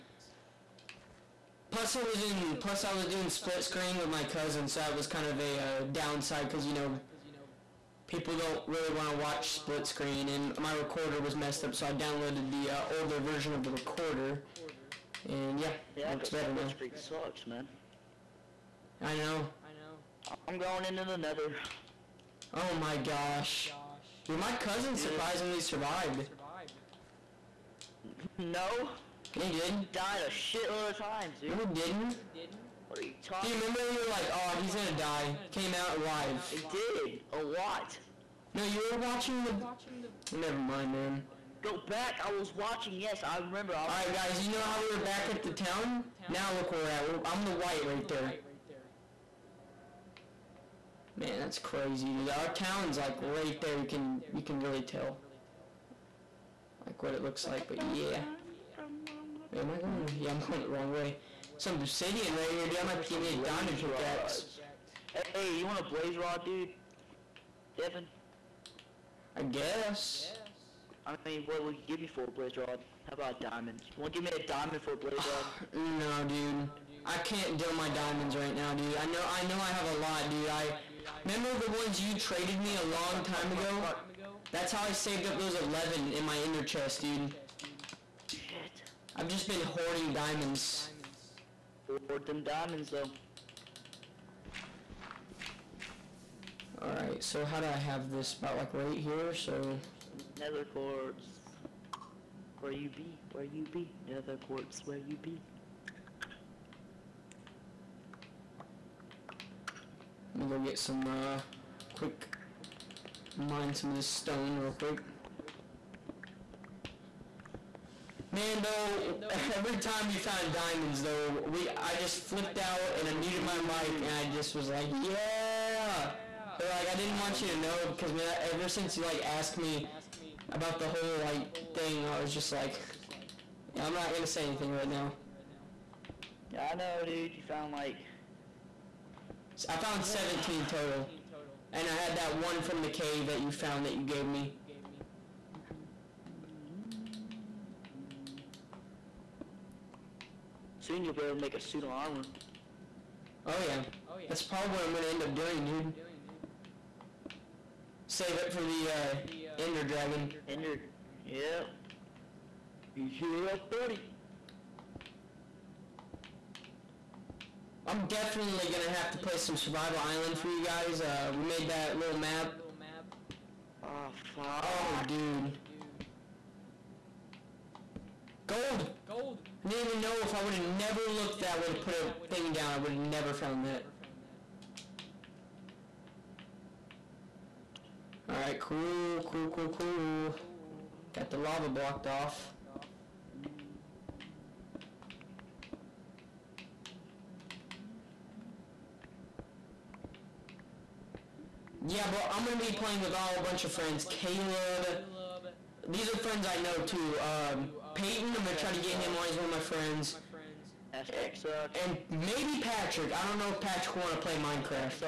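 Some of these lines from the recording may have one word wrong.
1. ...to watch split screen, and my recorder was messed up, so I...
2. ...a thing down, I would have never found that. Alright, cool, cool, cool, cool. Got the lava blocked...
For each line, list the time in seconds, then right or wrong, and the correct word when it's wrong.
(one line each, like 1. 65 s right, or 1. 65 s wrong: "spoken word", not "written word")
1. 9 s right
2. 181 s right.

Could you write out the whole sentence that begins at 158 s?
Save it for the uh, Ender Dragon.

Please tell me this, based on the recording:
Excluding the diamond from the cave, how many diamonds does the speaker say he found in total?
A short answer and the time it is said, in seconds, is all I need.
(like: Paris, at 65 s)
17, at 140 s.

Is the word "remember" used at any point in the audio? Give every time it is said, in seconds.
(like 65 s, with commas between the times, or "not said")
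33 s, 43 s, 81 s.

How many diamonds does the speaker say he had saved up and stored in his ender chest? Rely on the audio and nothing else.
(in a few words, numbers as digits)
11.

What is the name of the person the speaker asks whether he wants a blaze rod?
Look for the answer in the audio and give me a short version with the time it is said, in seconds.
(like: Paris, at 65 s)
Devin, at 67 s.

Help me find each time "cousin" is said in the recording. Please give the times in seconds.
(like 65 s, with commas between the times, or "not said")
4 s, 24 s.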